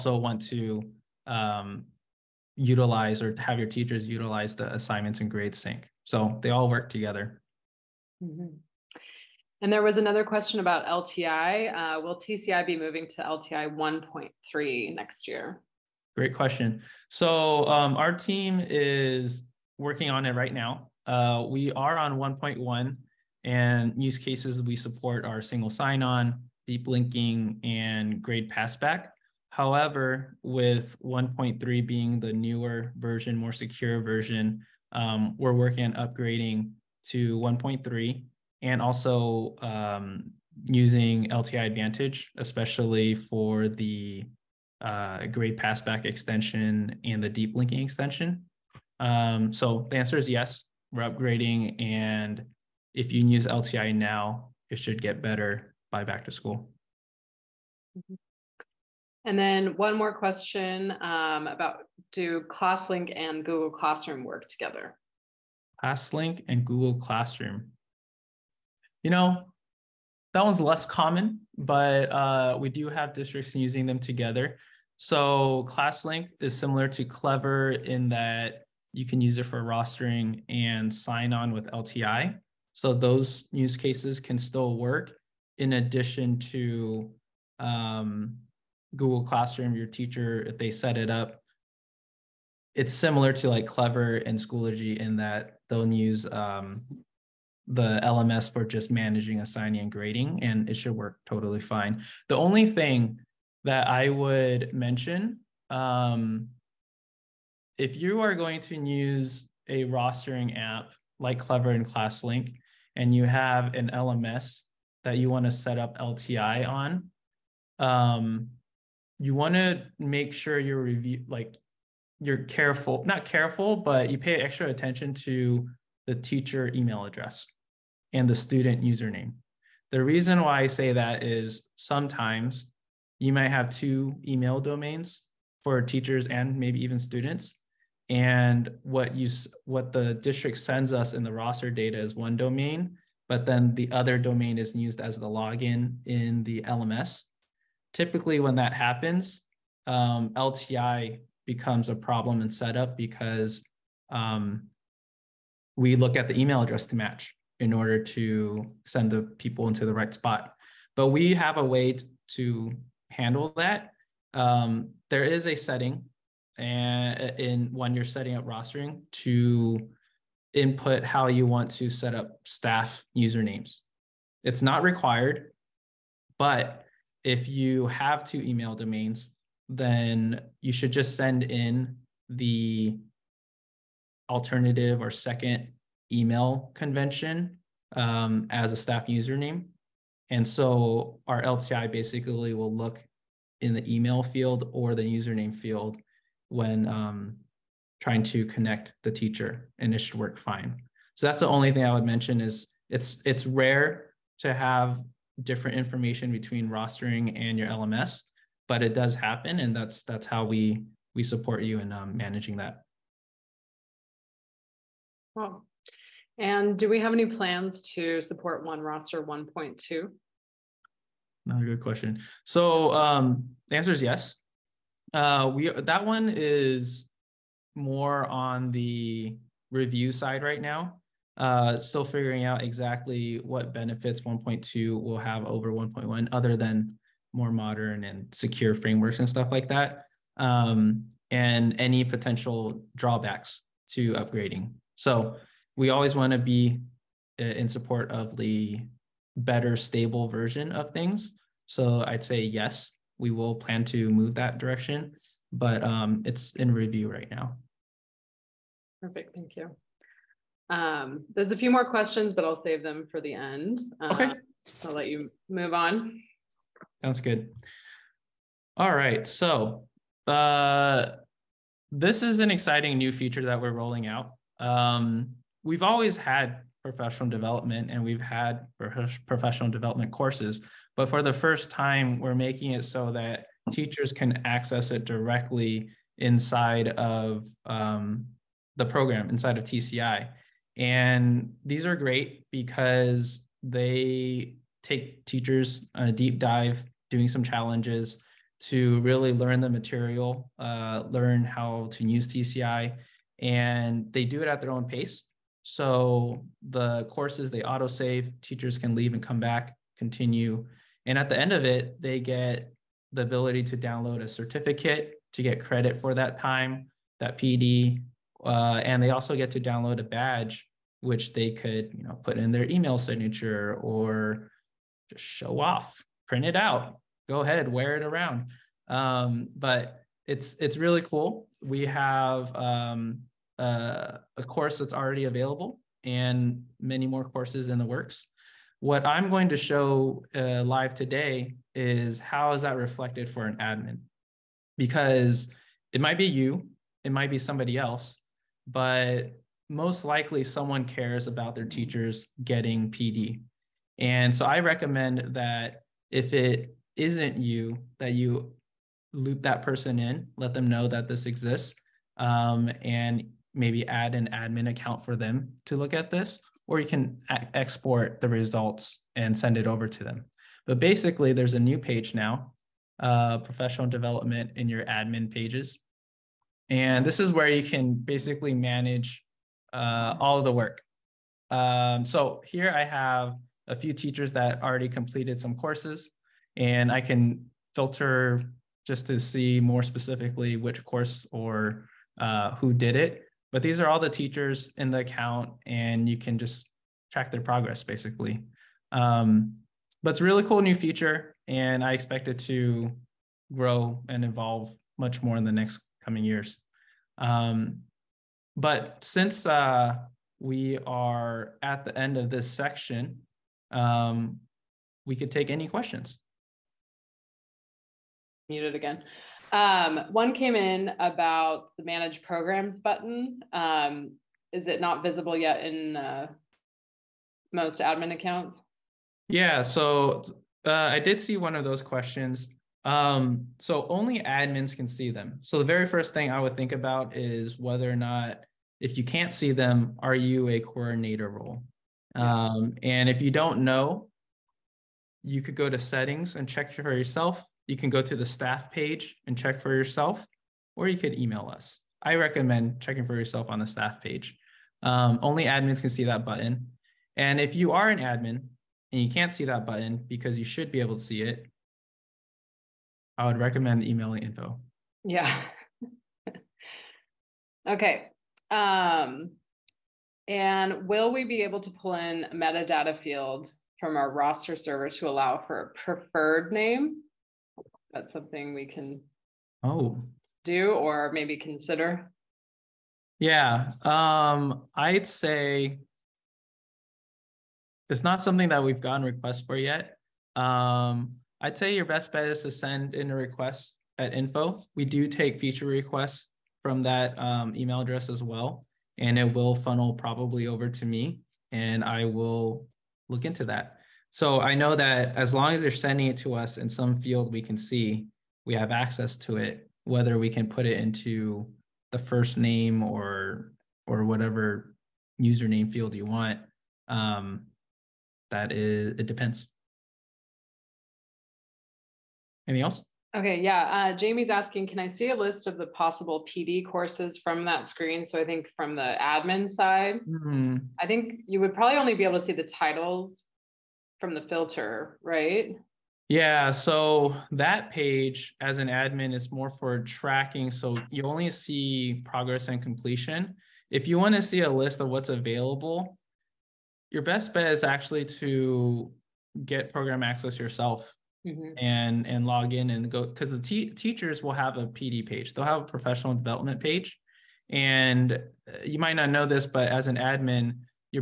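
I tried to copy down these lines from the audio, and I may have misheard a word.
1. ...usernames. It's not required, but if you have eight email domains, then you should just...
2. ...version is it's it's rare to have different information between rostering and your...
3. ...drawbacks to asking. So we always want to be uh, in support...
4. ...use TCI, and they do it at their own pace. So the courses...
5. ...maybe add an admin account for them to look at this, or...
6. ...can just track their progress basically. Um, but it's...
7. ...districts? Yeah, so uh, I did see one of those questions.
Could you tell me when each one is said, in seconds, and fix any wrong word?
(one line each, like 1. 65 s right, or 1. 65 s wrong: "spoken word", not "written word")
1. 173 s wrong: "two", not "eight"
2. 202 s wrong: "mention", not "version"
3. 242 s wrong: "upgrading", not "asking"
4. 302 s right
5. 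363 s right
6. 396 s right
7. 428 s wrong: "accounts", not "districts".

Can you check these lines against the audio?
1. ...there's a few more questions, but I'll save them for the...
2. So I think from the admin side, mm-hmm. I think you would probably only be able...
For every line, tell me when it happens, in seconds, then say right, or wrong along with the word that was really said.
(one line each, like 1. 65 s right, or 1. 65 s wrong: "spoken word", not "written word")
1. 261 s right
2. 528 s right.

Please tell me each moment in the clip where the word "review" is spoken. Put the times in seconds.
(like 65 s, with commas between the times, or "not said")
120 s, 229 s, 256 s.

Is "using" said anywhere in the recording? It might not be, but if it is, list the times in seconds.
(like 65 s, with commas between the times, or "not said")
40 s, 73 s.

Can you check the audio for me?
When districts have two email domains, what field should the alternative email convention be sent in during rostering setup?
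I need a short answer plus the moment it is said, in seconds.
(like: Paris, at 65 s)
staff username, at 188 s.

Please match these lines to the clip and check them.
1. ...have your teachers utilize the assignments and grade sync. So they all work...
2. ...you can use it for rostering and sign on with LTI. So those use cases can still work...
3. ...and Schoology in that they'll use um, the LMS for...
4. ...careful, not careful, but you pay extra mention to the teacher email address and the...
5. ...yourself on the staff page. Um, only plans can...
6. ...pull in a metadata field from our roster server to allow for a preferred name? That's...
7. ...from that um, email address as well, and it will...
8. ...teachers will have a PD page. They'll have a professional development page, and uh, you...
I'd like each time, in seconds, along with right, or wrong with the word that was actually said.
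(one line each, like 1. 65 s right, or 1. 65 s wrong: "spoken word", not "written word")
1. 3 s right
2. 78 s right
3. 94 s right
4. 122 s wrong: "attention", not "mention"
5. 453 s wrong: "admins", not "plans"
6. 471 s right
7. 496 s right
8. 553 s right.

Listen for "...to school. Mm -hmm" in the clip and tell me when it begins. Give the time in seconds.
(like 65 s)
56 s.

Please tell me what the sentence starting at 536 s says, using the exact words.
Yeah, so that page as an admin is more for tracking.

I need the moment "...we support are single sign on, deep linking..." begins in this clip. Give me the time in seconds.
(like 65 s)
24 s.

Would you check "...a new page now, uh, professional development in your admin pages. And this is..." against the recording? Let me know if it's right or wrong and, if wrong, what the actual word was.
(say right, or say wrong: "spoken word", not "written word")
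right.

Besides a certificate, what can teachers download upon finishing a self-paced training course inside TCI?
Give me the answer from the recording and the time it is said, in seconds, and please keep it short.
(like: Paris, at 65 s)
a badge, at 320 s.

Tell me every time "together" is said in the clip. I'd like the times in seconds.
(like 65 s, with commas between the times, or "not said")
6 s, 64 s, 73 s.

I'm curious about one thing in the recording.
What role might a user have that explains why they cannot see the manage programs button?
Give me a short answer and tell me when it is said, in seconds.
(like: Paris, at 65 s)
coordinator, at 440 s.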